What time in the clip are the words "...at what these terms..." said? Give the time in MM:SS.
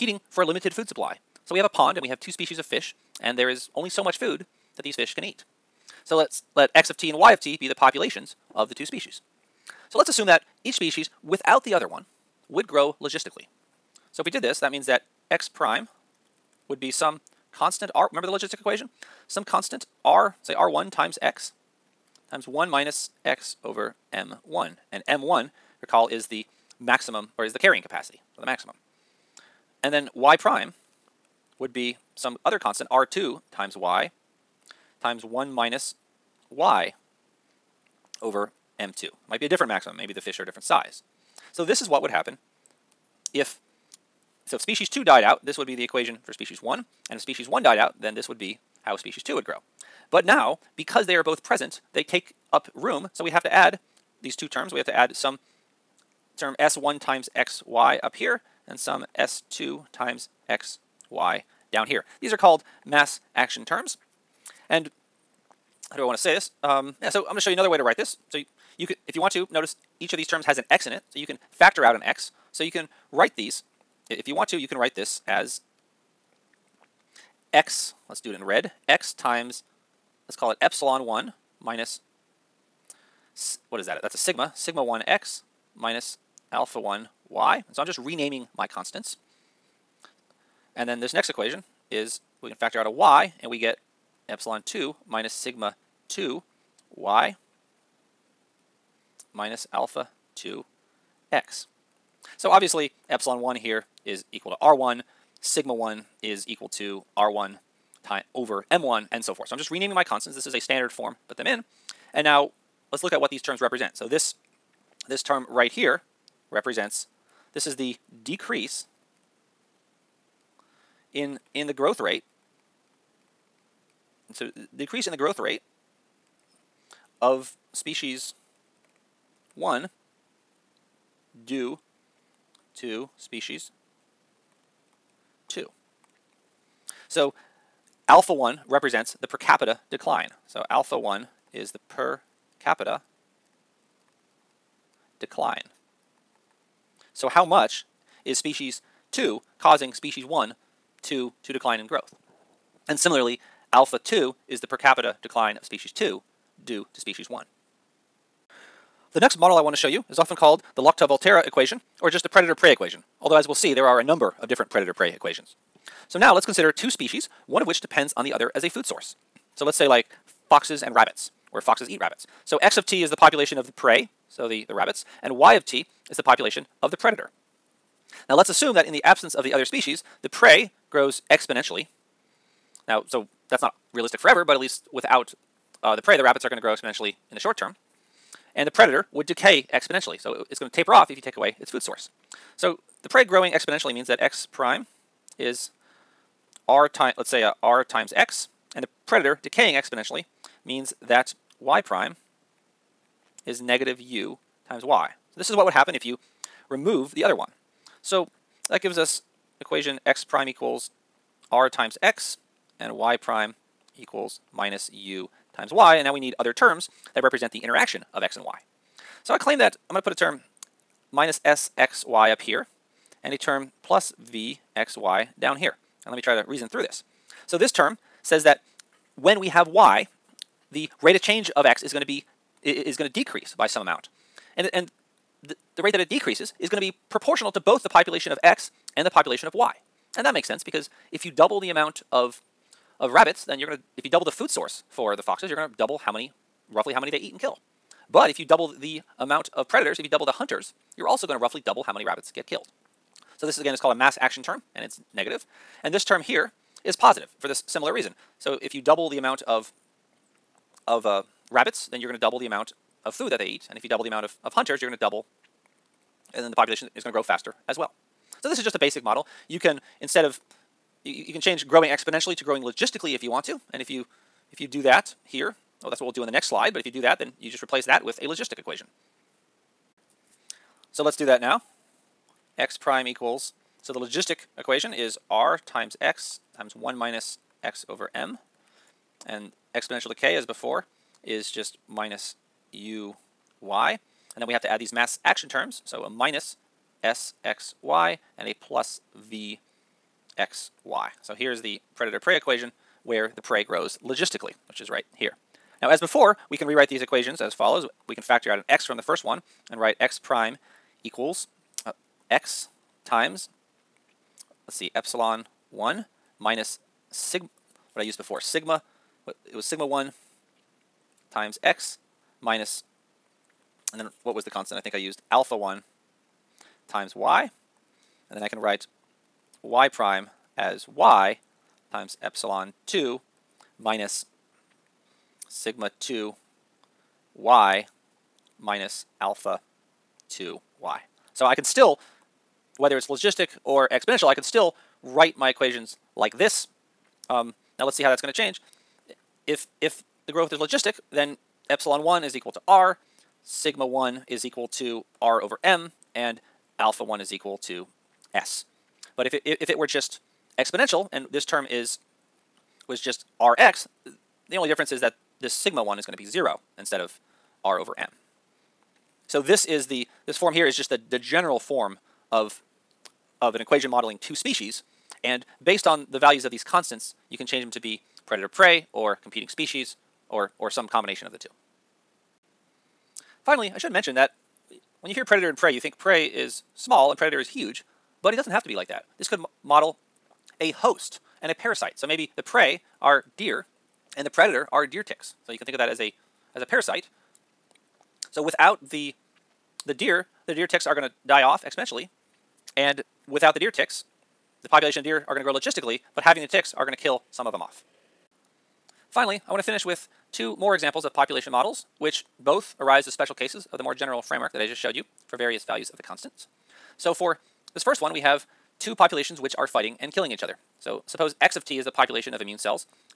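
01:53.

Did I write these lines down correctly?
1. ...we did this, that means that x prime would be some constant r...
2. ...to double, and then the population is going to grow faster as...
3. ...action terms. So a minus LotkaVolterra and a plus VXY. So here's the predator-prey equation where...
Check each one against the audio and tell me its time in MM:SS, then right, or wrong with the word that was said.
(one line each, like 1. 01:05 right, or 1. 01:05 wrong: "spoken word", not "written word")
1. 00:14 right
2. 04:24 right
3. 04:55 wrong: "SXY", not "LotkaVolterra".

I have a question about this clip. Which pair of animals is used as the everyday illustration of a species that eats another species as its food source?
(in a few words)
Foxes and rabbits.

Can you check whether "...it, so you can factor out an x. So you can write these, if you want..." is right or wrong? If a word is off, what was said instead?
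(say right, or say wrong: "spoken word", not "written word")
right.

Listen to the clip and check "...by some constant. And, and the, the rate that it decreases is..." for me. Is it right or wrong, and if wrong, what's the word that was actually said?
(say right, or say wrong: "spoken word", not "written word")
wrong: "amount", not "constant".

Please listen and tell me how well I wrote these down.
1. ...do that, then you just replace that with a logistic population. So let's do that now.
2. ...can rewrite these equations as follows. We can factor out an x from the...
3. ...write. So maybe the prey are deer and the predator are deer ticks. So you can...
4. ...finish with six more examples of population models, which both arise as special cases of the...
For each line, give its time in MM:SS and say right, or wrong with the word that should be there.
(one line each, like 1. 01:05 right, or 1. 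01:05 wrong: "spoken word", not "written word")
1. 04:36 wrong: "equation", not "population"
2. 05:06 right
3. 06:31 wrong: "parasite", not "write"
4. 06:49 wrong: "two", not "six".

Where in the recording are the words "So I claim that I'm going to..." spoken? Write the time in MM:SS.
03:39.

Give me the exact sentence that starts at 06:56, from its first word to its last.
So for this first one, we have two populations which are fighting and killing each other.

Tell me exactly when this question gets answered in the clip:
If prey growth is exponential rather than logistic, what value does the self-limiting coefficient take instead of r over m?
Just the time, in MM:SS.
06:06.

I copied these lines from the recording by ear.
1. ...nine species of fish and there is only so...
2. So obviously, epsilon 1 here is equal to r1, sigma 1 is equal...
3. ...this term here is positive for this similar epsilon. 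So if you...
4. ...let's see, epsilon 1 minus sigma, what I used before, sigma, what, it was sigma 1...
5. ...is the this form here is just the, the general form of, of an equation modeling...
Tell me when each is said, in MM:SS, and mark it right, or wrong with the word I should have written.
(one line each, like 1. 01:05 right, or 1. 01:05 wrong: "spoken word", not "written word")
1. 00:02 wrong: "two", not "nine"
2. 01:42 right
3. 04:15 wrong: "reason", not "epsilon"
4. 05:14 right
5. 06:09 right.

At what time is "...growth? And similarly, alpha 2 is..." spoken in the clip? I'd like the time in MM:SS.
02:31.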